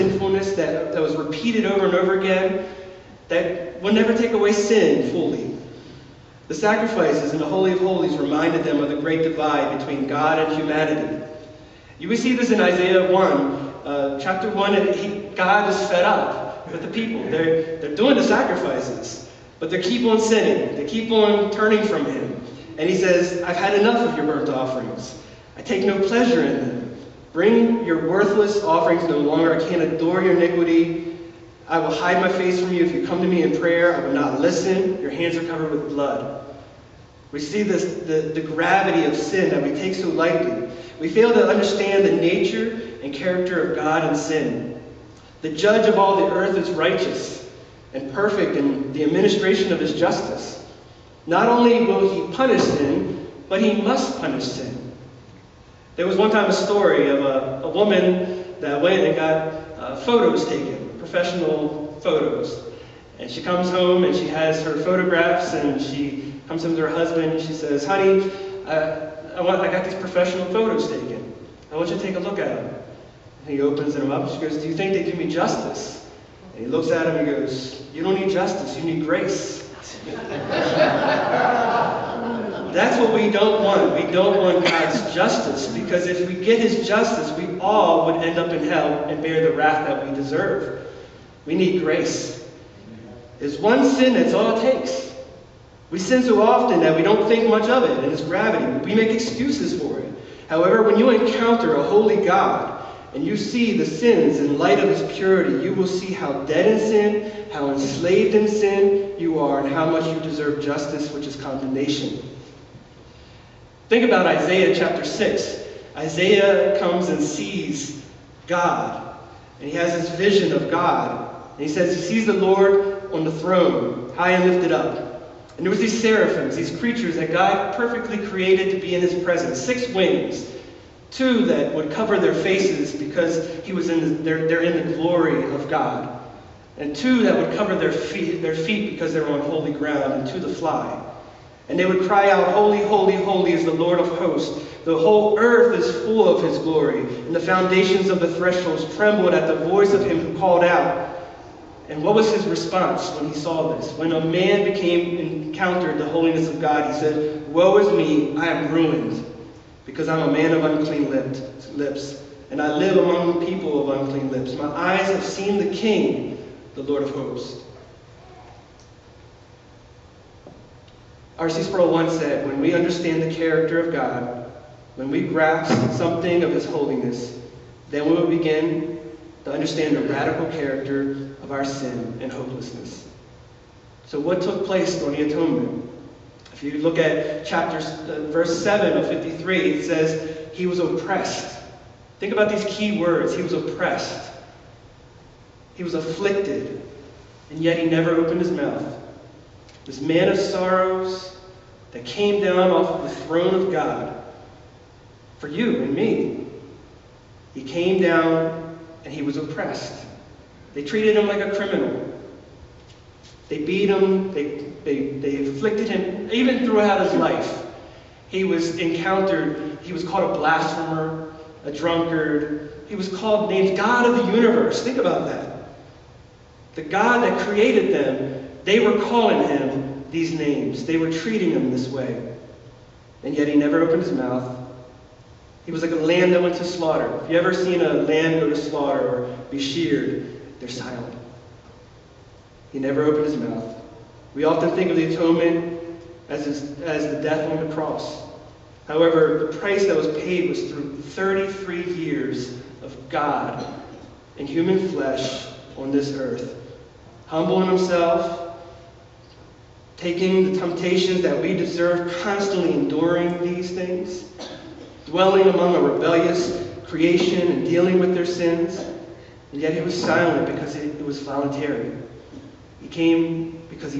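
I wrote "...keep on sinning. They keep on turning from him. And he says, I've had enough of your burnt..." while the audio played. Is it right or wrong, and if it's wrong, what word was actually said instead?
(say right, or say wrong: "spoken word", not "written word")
right.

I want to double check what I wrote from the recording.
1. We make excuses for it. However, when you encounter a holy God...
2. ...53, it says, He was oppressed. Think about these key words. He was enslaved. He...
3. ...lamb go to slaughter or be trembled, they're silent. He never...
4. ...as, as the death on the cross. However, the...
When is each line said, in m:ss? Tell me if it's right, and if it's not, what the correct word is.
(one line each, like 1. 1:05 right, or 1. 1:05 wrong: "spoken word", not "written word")
1. 1:38 right
2. 3:09 wrong: "oppressed", not "enslaved"
3. 3:57 wrong: "sheared", not "trembled"
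4. 4:06 right.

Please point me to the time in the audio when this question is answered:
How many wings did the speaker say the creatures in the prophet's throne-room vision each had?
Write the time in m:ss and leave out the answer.
2:09.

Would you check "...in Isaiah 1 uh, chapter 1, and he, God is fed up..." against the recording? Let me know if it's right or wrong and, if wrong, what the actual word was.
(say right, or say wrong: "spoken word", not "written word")
right.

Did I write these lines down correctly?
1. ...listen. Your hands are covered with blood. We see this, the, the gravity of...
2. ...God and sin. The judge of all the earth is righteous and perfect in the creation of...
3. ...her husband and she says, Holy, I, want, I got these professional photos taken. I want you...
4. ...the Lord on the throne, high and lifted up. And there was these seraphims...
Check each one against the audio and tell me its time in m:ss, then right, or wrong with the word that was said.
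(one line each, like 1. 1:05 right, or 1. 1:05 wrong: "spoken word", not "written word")
1. 0:34 right
2. 0:43 wrong: "administration", not "creation"
3. 1:06 wrong: "Honey", not "Holy"
4. 2:02 right.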